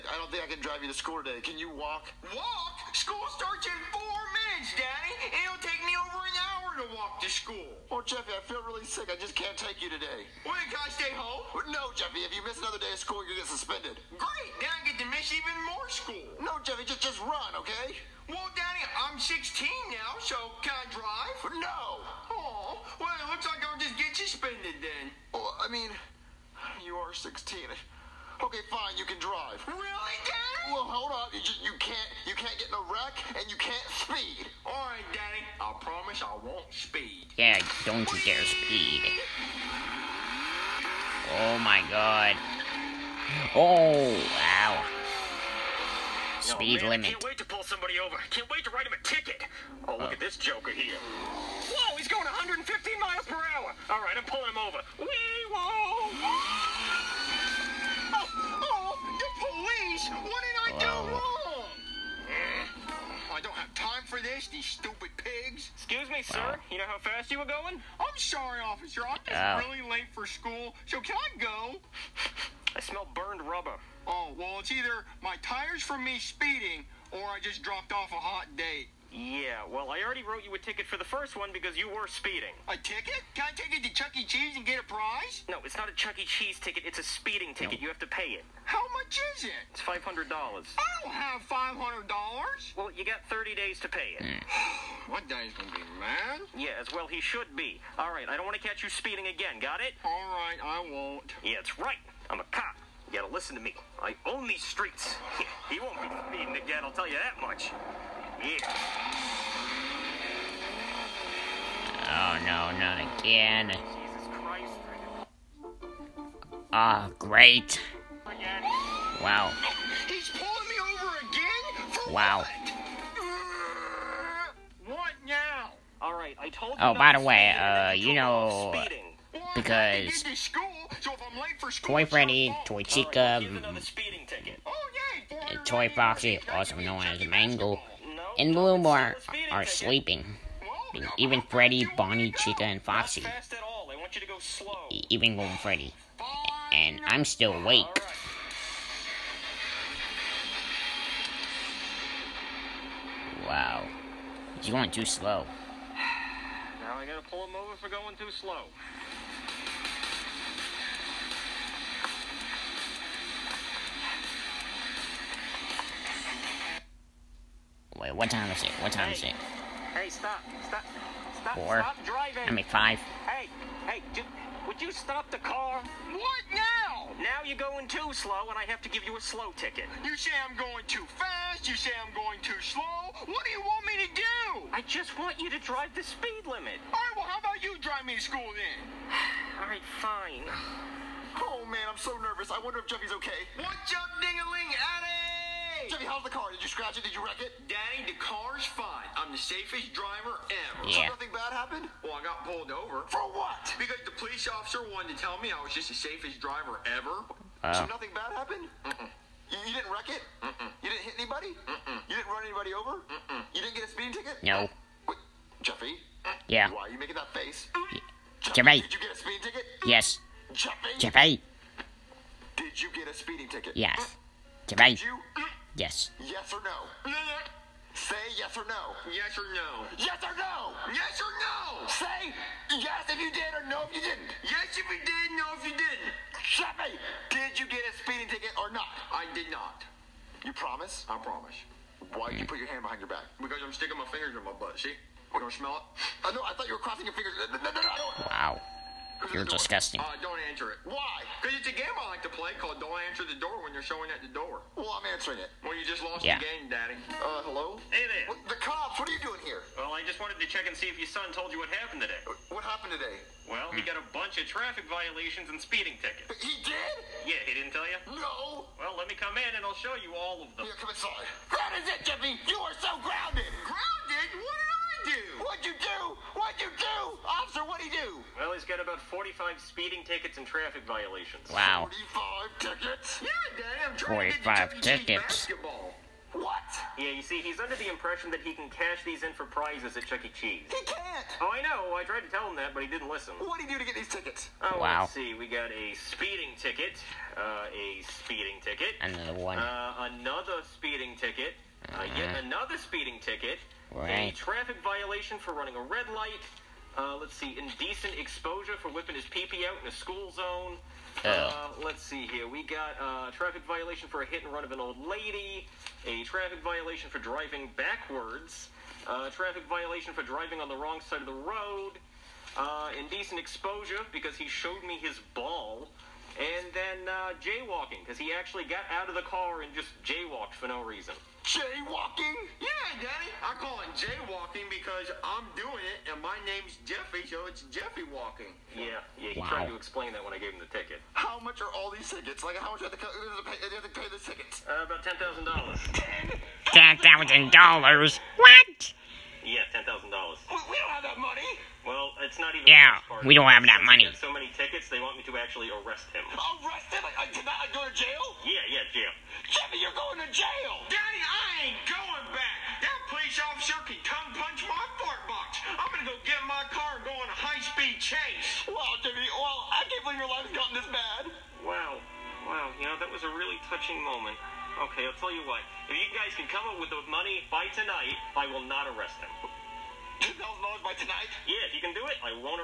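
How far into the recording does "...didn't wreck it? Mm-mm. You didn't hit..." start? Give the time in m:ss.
3:29.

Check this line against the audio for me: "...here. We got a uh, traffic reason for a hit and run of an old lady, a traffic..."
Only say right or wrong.
wrong.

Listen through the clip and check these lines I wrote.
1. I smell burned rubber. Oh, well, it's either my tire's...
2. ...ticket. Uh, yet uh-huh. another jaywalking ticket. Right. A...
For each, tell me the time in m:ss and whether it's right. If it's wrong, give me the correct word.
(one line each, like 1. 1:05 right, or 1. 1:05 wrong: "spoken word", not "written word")
1. 1:12 right
2. 5:01 wrong: "speeding", not "jaywalking".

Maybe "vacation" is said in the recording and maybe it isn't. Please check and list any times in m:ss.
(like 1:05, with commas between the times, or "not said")
not said.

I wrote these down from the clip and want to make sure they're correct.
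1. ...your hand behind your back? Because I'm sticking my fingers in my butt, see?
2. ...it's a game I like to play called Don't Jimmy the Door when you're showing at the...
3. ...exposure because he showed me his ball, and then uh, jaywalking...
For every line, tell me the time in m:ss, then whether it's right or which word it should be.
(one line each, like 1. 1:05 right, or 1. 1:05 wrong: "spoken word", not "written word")
1. 4:02 right
2. 4:11 wrong: "Answer", not "Jimmy"
3. 5:23 right.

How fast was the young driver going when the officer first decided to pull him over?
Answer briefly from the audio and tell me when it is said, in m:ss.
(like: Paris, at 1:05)
115 miles per hour, at 0:52.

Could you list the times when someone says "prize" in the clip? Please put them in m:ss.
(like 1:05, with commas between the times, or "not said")
1:24, 4:49.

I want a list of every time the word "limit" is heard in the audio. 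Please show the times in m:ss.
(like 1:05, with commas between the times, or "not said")
0:47, 3:06.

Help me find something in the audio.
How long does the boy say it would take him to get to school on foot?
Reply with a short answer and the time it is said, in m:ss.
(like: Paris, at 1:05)
Over an hour, at 0:05.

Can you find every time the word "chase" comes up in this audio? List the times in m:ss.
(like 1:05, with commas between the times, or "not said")
6:07.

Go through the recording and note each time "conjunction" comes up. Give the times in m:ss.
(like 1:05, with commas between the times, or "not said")
not said.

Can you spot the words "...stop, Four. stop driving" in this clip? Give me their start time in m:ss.
2:51.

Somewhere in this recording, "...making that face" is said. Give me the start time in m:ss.
3:36.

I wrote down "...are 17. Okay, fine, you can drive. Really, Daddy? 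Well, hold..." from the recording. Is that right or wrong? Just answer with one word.
wrong.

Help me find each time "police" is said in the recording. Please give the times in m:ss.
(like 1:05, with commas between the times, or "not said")
3:24, 6:03.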